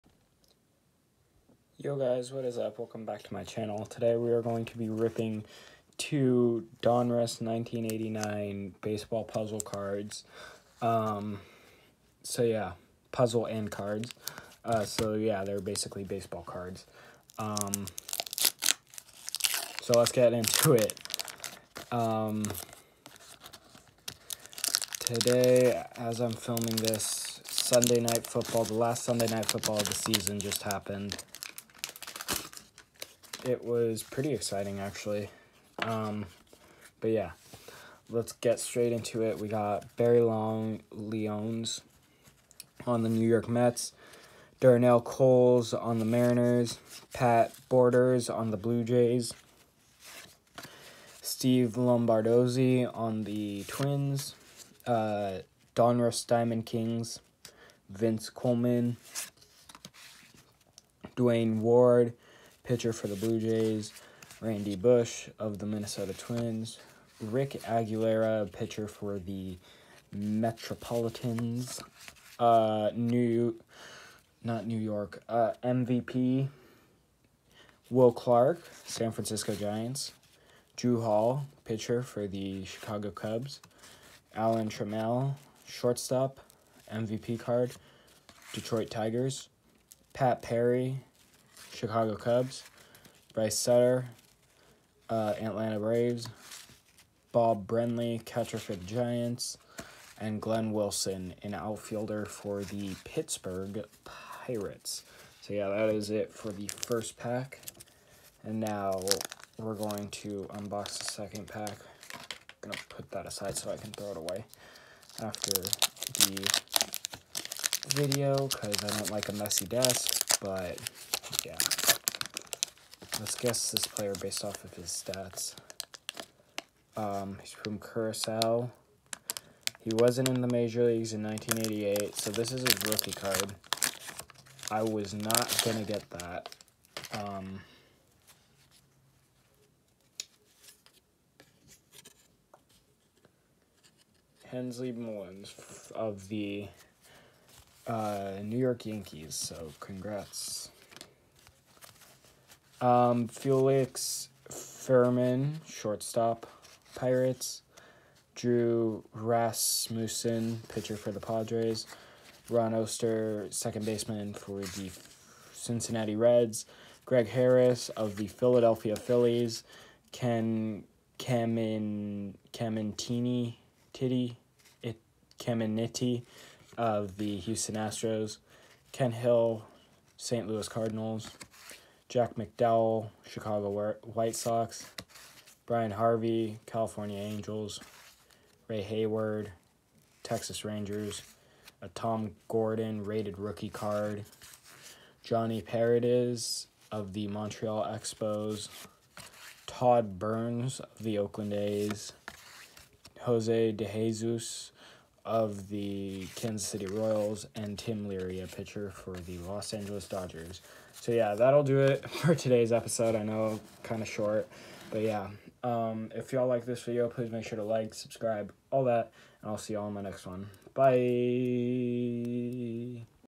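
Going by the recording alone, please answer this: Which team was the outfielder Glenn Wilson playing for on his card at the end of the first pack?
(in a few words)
Pittsburgh Pirates.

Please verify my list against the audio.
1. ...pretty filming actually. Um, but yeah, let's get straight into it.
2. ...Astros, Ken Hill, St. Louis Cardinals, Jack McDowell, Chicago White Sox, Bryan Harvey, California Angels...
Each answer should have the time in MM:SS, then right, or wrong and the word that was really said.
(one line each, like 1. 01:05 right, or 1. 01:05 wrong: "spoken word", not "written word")
1. 00:34 wrong: "exciting", not "filming"
2. 02:57 right.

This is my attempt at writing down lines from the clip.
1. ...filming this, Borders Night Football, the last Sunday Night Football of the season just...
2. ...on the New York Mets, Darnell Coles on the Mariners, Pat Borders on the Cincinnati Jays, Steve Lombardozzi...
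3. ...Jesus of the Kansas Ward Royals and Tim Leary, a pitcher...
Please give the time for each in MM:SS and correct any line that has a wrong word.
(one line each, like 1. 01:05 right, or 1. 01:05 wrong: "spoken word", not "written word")
1. 00:26 wrong: "Sunday", not "Borders"
2. 00:42 wrong: "Blue", not "Cincinnati"
3. 03:23 wrong: "City", not "Ward".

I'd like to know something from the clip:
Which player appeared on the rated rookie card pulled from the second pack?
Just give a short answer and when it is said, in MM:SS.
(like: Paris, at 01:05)
Tom Gordon, at 03:11.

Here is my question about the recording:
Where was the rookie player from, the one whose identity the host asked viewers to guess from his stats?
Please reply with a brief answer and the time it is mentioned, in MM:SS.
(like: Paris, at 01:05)
Curacao, at 02:07.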